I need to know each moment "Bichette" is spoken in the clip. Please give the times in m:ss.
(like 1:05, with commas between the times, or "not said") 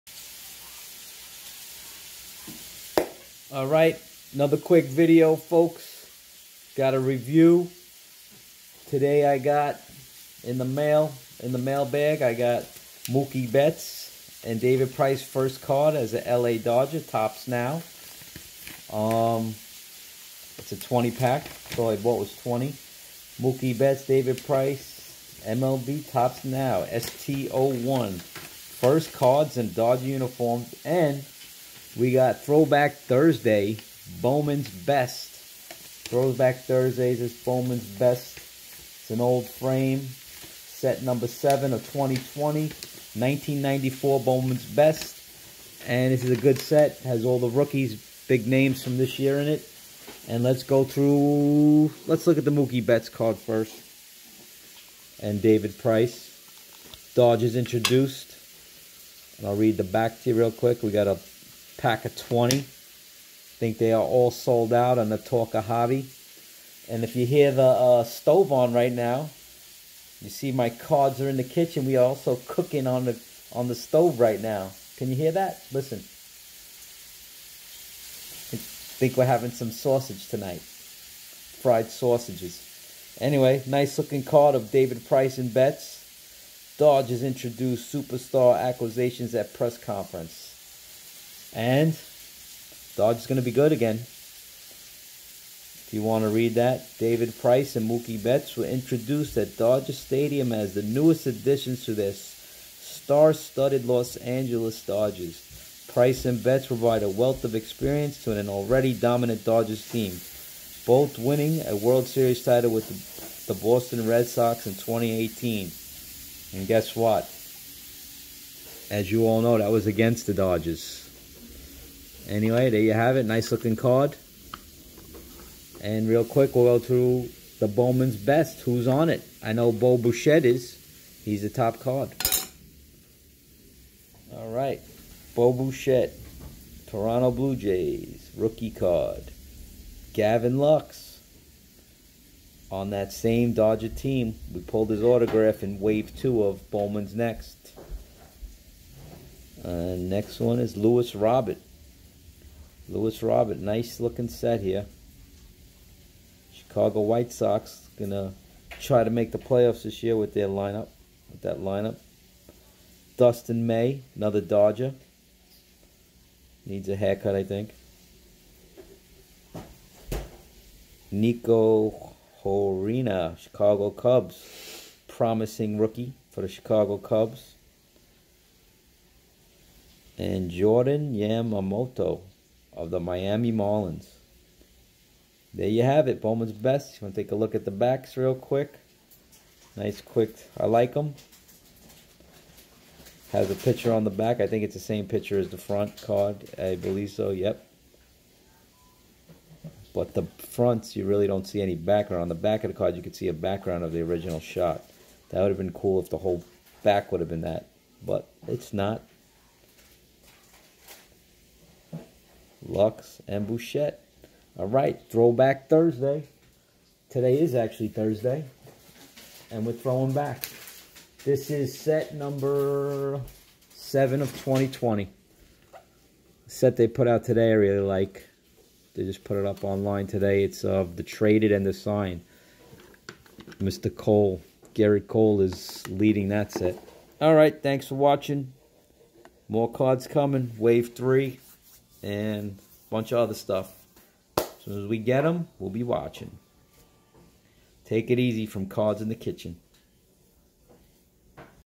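2:09, 2:15, 3:33.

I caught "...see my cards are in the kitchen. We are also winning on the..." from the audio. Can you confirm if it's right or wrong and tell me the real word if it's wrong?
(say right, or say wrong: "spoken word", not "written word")
wrong: "cooking", not "winning".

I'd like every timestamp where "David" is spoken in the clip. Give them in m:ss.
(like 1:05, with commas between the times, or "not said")
0:14, 0:24, 0:55, 1:24, 1:36.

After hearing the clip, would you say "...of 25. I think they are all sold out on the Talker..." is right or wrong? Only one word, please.
wrong.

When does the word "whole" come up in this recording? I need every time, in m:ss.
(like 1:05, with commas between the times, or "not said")
3:26.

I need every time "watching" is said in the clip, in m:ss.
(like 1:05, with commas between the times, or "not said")
3:57, 4:05.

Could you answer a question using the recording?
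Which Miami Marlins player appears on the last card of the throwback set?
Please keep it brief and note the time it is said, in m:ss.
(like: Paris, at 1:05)
Jordan Yamamoto, at 3:00.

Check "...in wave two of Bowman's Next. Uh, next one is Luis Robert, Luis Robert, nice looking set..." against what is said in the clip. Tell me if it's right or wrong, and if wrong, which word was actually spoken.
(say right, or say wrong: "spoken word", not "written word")
right.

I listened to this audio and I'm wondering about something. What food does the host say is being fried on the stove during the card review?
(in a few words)
Sausage.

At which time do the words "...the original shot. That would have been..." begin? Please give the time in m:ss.
3:23.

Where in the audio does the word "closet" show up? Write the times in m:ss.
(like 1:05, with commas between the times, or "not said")
not said.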